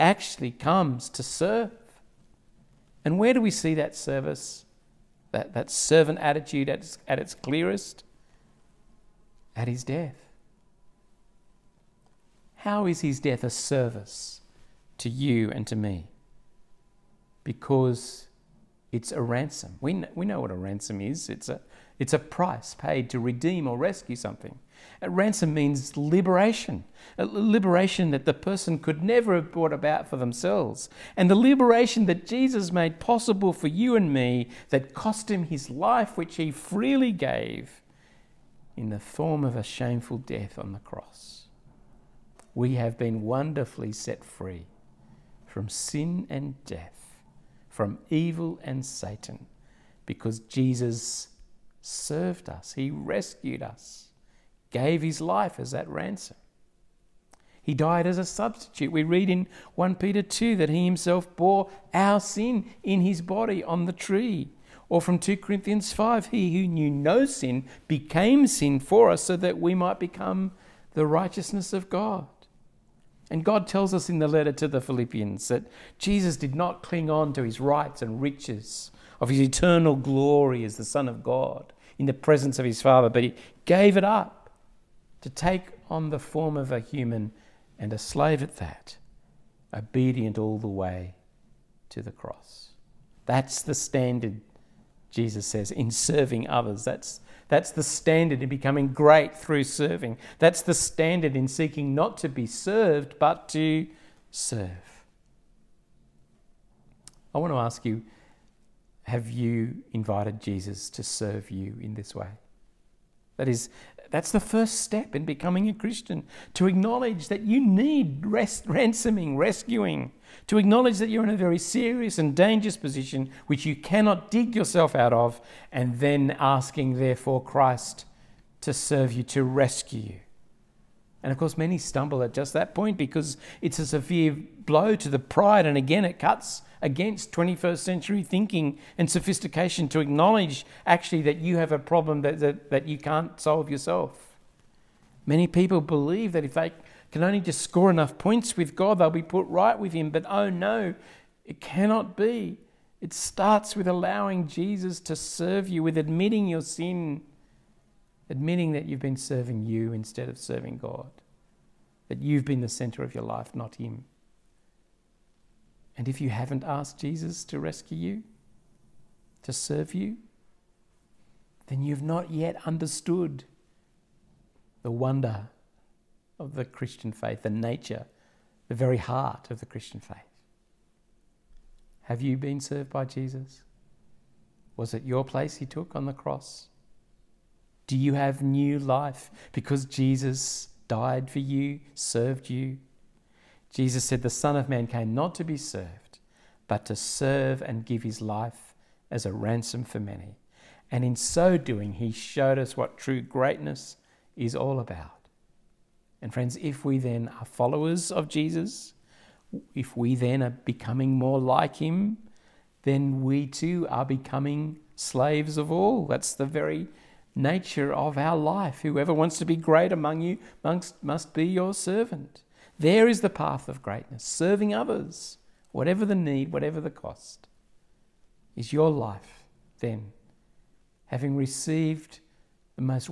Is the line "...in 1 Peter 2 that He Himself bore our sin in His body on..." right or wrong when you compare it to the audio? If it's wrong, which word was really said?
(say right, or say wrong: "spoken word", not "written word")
right.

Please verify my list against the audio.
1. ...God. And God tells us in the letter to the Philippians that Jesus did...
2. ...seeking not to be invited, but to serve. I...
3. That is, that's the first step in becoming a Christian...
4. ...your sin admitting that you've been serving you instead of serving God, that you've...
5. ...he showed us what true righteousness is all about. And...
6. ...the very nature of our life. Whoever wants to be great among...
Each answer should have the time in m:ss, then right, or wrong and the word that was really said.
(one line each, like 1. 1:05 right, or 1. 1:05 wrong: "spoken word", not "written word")
1. 1:11 right
2. 1:41 wrong: "served", not "invited"
3. 1:53 right
4. 2:36 right
5. 3:21 wrong: "greatness", not "righteousness"
6. 3:36 right.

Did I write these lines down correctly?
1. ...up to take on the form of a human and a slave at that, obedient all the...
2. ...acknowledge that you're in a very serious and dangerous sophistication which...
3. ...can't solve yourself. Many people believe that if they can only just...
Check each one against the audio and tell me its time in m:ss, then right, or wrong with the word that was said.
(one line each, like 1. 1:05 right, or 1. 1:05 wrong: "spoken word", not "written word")
1. 1:24 right
2. 2:00 wrong: "position", not "sophistication"
3. 2:22 right.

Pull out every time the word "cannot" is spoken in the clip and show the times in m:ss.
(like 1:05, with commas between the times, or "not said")
2:03, 2:31.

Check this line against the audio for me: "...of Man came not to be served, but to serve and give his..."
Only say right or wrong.
right.